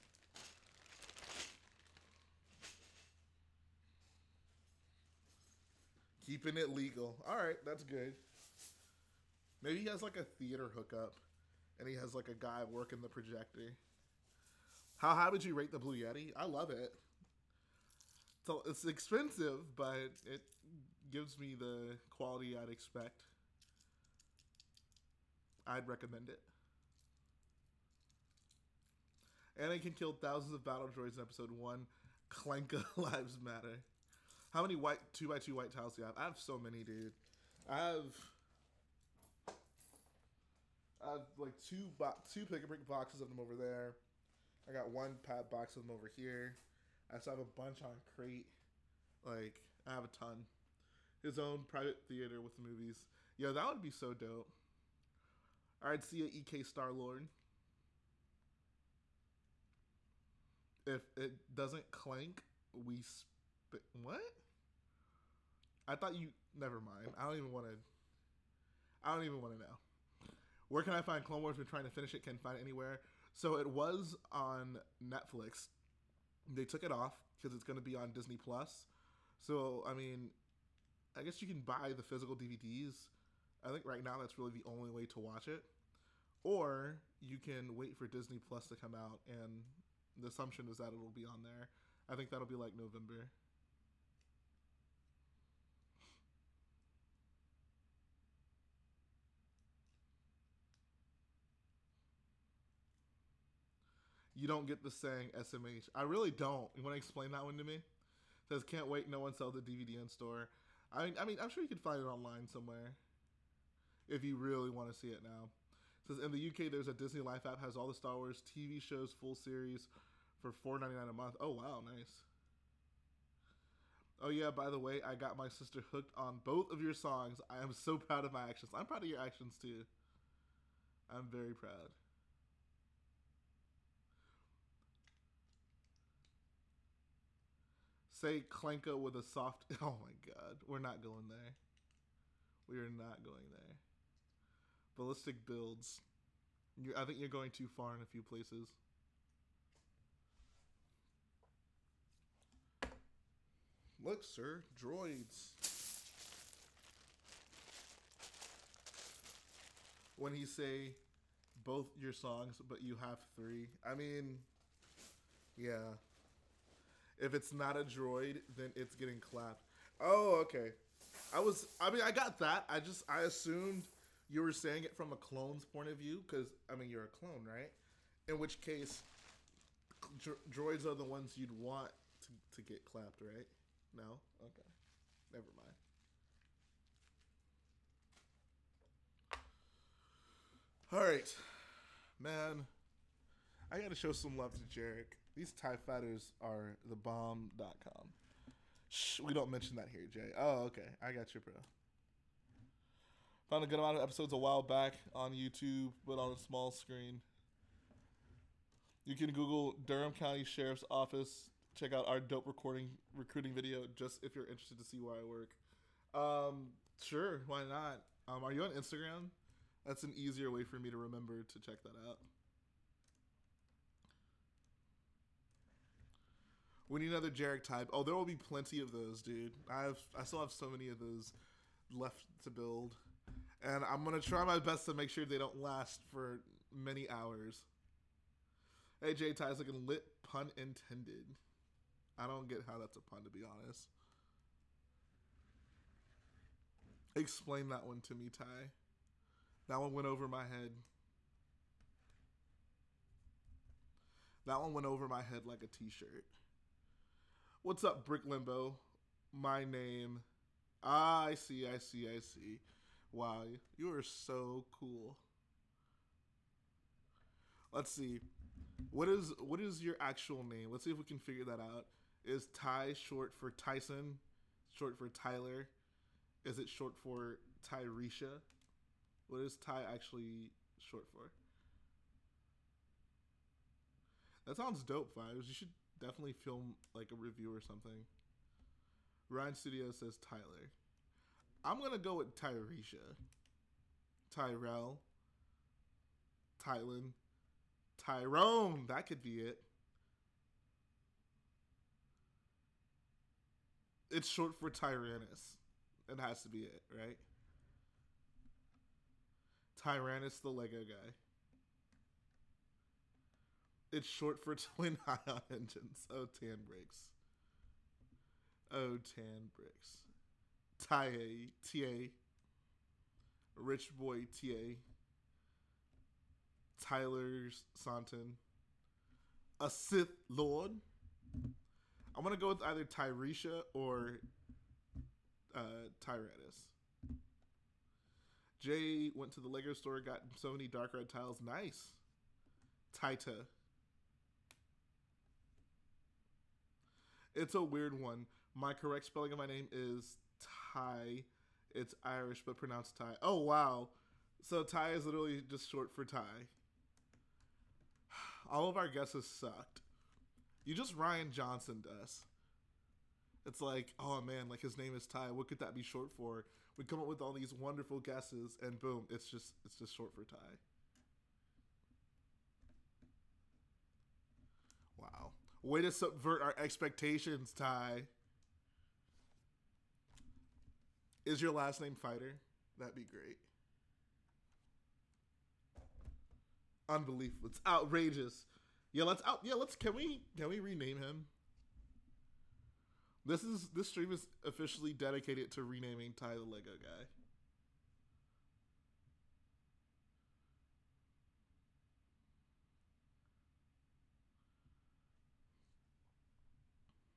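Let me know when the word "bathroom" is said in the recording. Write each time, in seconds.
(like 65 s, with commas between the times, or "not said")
not said.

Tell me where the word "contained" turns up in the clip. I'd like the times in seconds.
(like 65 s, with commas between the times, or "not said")
not said.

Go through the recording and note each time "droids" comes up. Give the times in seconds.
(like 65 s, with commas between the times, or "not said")
30 s, 154 s, 167 s, 180 s.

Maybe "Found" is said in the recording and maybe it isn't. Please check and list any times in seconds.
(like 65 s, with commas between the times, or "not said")
203 s.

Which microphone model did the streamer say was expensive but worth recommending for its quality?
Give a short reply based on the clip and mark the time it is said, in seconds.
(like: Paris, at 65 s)
Blue Yeti, at 15 s.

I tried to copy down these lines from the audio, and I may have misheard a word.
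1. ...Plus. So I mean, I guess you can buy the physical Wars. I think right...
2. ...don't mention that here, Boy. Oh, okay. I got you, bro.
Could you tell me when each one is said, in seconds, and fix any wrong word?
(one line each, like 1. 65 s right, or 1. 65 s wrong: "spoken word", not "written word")
1. 78 s wrong: "DVDs", not "Wars"
2. 199 s wrong: "Jay", not "Boy".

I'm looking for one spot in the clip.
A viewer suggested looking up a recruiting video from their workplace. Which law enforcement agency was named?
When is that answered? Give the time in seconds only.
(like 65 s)
209 s.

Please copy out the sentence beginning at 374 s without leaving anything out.
Wow, way to subvert our expectations, Ty.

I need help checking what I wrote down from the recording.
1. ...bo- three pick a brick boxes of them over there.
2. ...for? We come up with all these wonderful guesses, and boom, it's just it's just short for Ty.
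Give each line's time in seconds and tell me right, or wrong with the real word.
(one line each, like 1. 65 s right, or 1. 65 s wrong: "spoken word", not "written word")
1. 41 s wrong: "two", not "three"
2. 366 s right.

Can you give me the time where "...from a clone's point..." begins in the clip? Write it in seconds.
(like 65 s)
174 s.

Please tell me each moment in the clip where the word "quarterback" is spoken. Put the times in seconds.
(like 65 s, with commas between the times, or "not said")
not said.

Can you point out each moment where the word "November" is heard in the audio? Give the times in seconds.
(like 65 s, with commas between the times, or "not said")
92 s.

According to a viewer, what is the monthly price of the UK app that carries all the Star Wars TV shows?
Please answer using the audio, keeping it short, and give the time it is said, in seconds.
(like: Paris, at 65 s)
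4.99, at 120 s.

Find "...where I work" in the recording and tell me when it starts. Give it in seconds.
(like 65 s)
215 s.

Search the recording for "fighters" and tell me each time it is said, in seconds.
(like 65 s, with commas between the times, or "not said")
195 s, 381 s.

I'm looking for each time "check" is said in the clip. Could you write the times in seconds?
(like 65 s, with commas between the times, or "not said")
211 s, 221 s.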